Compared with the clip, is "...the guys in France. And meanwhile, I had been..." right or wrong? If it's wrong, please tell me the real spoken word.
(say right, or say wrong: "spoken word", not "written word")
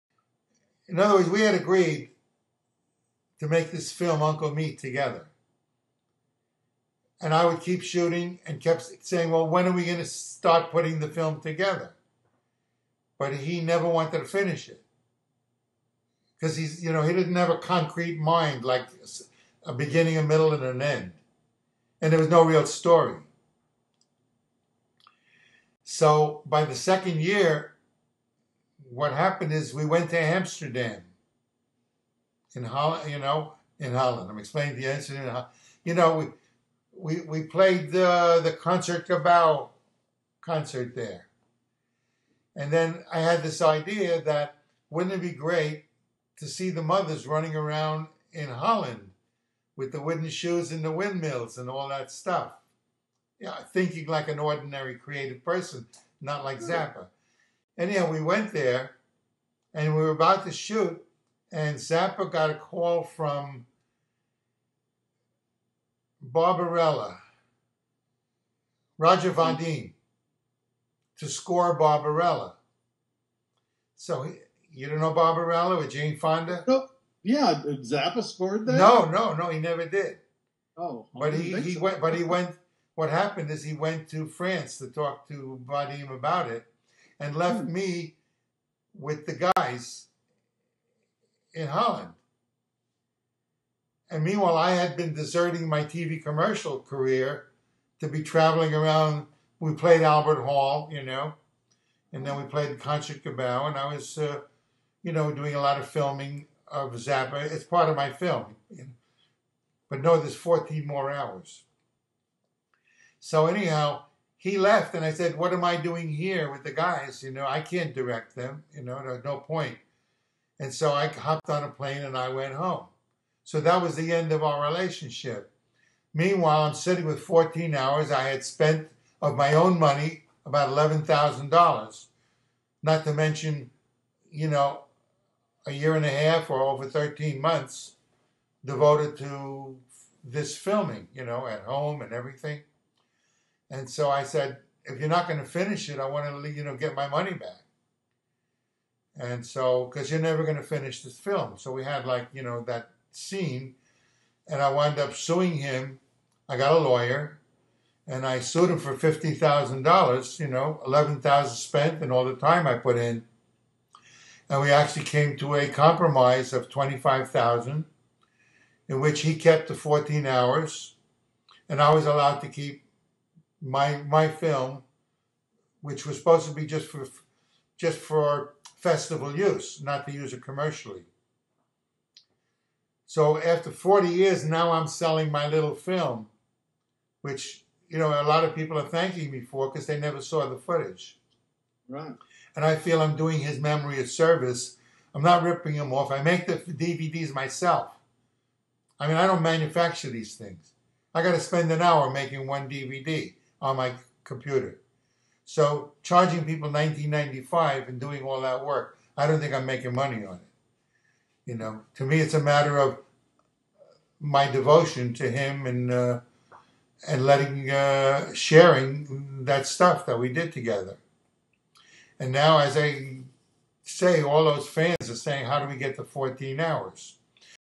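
wrong: "Holland", not "France".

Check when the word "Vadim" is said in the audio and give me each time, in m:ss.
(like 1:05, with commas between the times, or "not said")
1:09, 1:25.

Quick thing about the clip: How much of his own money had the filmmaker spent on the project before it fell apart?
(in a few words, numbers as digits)
$11,000.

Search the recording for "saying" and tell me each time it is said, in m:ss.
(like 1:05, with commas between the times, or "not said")
0:09, 3:45.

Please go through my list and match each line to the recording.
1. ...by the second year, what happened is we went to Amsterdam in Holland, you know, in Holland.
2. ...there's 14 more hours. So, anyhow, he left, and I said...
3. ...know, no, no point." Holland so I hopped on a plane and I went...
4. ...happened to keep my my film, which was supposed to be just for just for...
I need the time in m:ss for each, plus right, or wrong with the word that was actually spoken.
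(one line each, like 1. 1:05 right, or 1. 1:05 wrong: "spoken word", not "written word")
1. 0:26 right
2. 1:50 right
3. 1:58 wrong: "And", not "Holland"
4. 2:52 wrong: "allowed", not "happened".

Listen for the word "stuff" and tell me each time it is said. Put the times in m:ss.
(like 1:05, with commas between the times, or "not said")
0:52, 3:39.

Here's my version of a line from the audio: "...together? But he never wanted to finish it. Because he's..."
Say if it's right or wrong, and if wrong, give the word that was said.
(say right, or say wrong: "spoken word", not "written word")
right.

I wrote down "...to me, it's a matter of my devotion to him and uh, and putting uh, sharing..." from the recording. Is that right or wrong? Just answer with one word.
wrong.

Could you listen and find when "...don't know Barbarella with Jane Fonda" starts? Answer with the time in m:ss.
1:14.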